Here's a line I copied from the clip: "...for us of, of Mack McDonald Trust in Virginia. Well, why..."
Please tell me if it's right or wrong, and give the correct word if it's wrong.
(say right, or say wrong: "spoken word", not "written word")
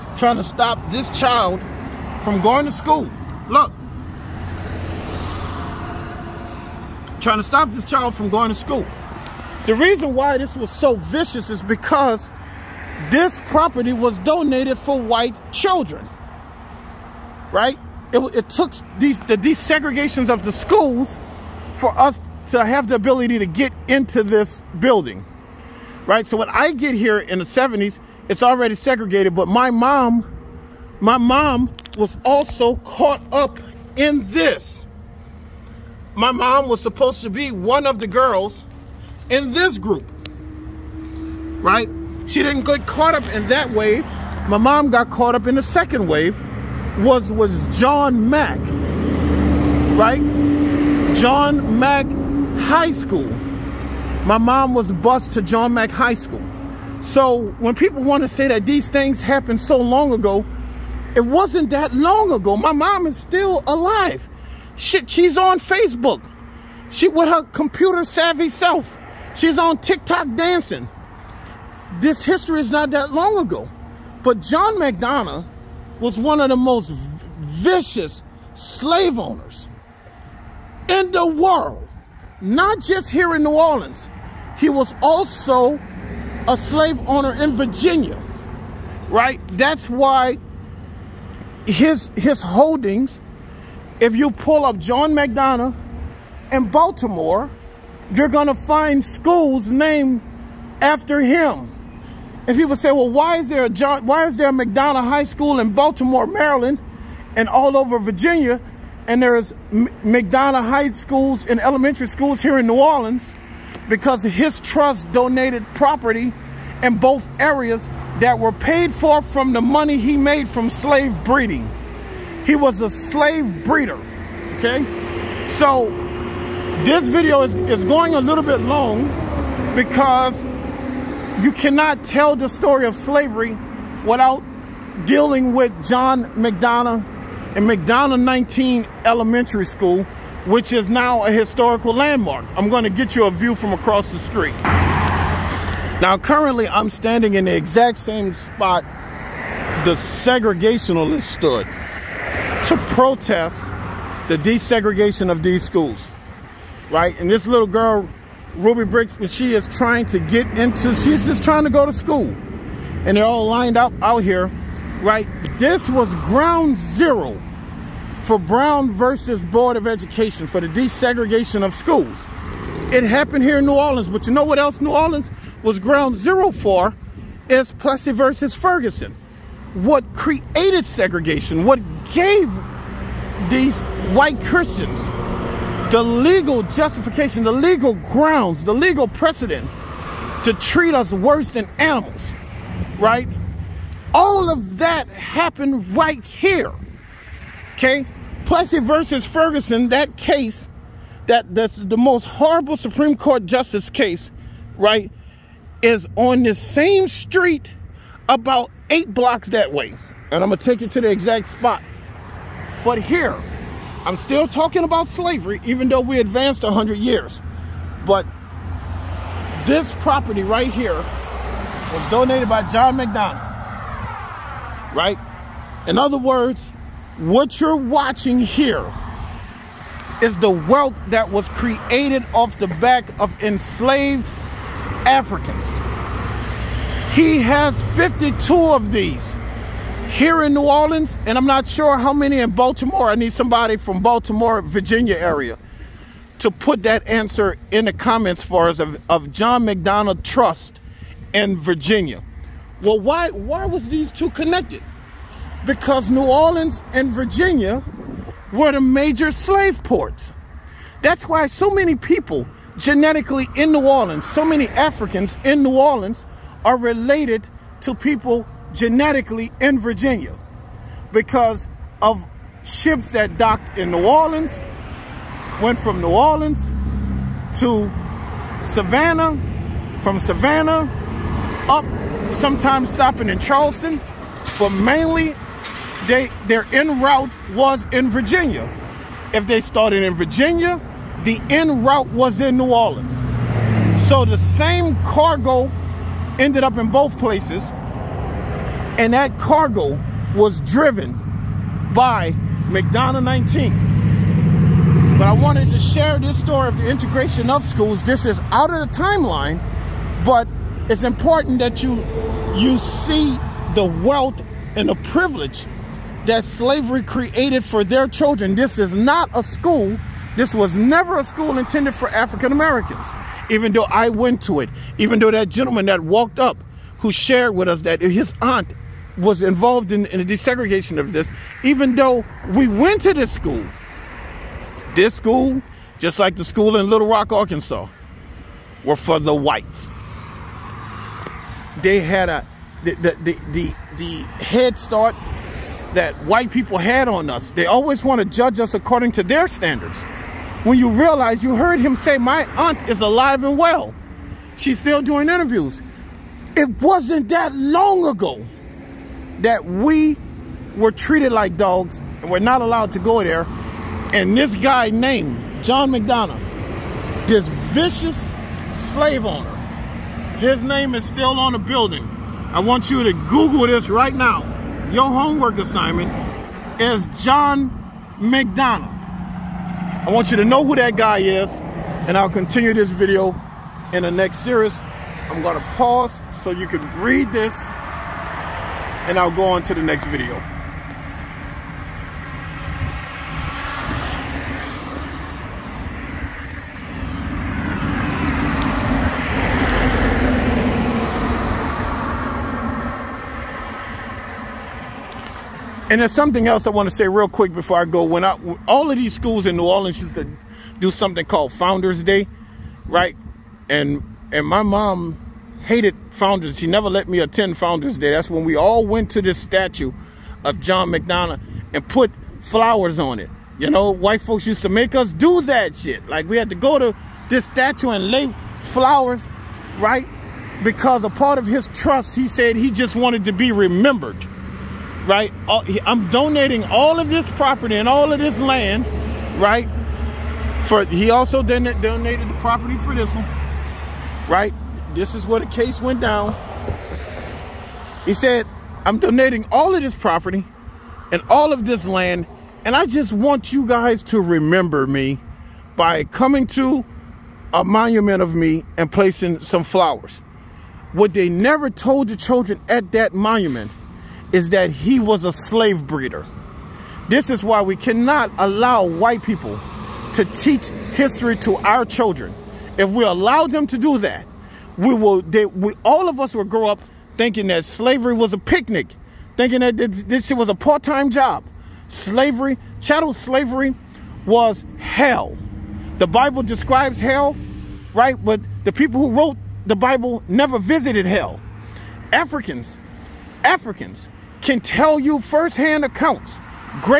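wrong: "John", not "Mack".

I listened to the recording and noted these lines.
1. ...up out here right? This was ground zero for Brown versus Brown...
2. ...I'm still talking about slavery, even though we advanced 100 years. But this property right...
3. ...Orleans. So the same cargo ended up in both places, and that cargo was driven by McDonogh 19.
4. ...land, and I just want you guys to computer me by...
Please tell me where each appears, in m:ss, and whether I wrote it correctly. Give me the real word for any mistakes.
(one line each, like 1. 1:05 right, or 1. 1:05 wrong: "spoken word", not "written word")
1. 2:43 wrong: "Board", not "Brown"
2. 3:34 right
3. 4:52 right
4. 7:31 wrong: "remember", not "computer".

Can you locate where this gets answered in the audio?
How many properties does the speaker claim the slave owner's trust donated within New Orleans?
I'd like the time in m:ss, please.
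3:57.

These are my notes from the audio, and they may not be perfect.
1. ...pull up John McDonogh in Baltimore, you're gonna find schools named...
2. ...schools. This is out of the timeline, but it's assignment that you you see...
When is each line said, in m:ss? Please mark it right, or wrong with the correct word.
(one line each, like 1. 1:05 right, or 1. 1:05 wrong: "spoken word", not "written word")
1. 1:34 right
2. 5:07 wrong: "important", not "assignment".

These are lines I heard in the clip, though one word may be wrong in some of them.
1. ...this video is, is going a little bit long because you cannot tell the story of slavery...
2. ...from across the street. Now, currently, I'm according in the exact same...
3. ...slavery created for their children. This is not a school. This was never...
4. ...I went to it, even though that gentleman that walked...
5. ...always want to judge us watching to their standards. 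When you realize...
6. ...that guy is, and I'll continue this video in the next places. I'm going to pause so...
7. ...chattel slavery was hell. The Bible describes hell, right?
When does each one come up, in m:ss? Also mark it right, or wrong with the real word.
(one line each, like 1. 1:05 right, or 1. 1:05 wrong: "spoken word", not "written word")
1. 2:06 right
2. 2:23 wrong: "standing", not "according"
3. 5:16 right
4. 5:23 right
5. 5:47 wrong: "according", not "watching"
6. 6:20 wrong: "series", not "places"
7. 8:02 right.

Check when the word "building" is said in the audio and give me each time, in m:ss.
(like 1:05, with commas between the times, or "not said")
0:24, 6:11.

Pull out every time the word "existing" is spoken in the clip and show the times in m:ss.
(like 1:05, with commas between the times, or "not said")
not said.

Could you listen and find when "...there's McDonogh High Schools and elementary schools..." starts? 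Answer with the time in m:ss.
1:49.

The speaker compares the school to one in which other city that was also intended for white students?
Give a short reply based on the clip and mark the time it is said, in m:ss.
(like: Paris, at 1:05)
Little Rock, Arkansas, at 5:36.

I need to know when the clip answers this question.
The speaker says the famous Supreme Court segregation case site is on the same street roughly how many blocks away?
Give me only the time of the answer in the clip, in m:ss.
3:28.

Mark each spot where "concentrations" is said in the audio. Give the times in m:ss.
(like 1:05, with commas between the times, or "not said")
not said.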